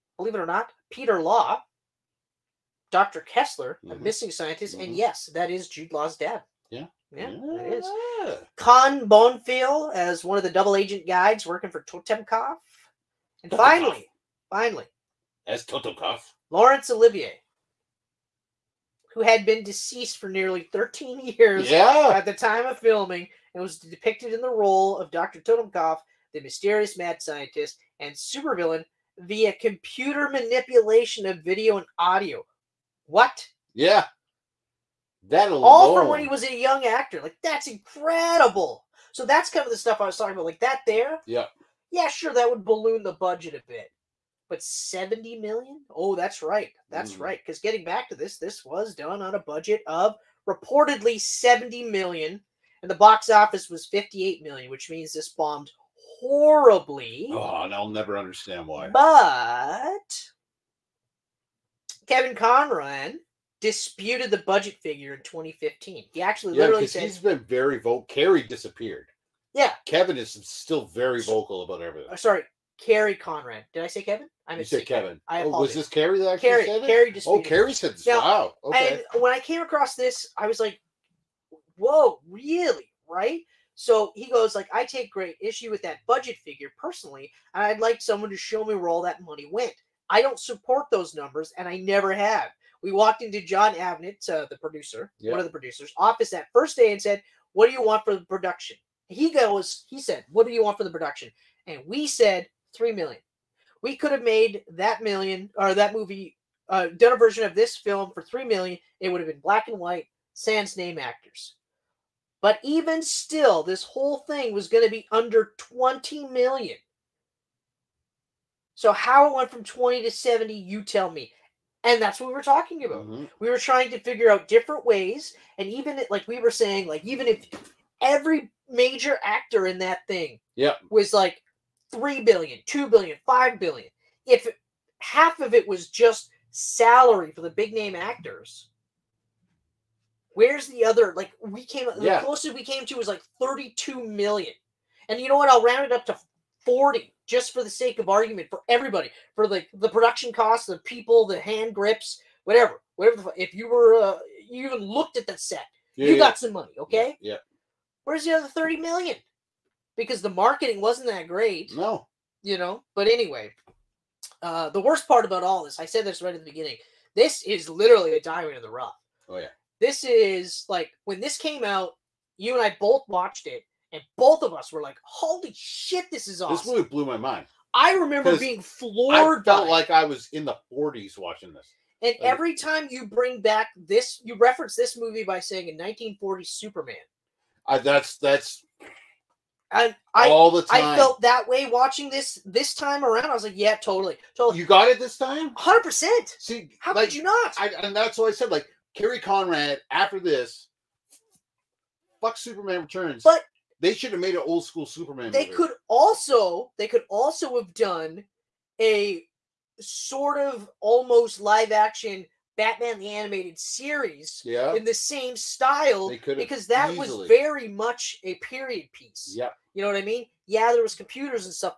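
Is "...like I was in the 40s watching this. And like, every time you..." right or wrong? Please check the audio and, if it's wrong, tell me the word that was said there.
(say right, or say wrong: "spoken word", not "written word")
right.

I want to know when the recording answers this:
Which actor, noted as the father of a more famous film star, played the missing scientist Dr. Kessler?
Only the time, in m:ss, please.
0:00.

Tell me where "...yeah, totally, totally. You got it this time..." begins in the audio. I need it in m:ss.
3:13.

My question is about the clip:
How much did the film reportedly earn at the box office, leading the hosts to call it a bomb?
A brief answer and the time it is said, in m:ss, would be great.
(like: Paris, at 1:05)
58 million, at 0:53.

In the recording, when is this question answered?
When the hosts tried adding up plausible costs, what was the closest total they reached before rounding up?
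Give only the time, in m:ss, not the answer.
2:23.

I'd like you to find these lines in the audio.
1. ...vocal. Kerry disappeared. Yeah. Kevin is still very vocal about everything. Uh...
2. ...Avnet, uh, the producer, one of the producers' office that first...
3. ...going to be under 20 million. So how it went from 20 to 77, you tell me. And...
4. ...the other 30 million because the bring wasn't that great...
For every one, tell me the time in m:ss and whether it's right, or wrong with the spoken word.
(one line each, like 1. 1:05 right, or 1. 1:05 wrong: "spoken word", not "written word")
1. 1:07 right
2. 1:33 right
3. 1:54 wrong: "70", not "77"
4. 2:38 wrong: "marketing", not "bring".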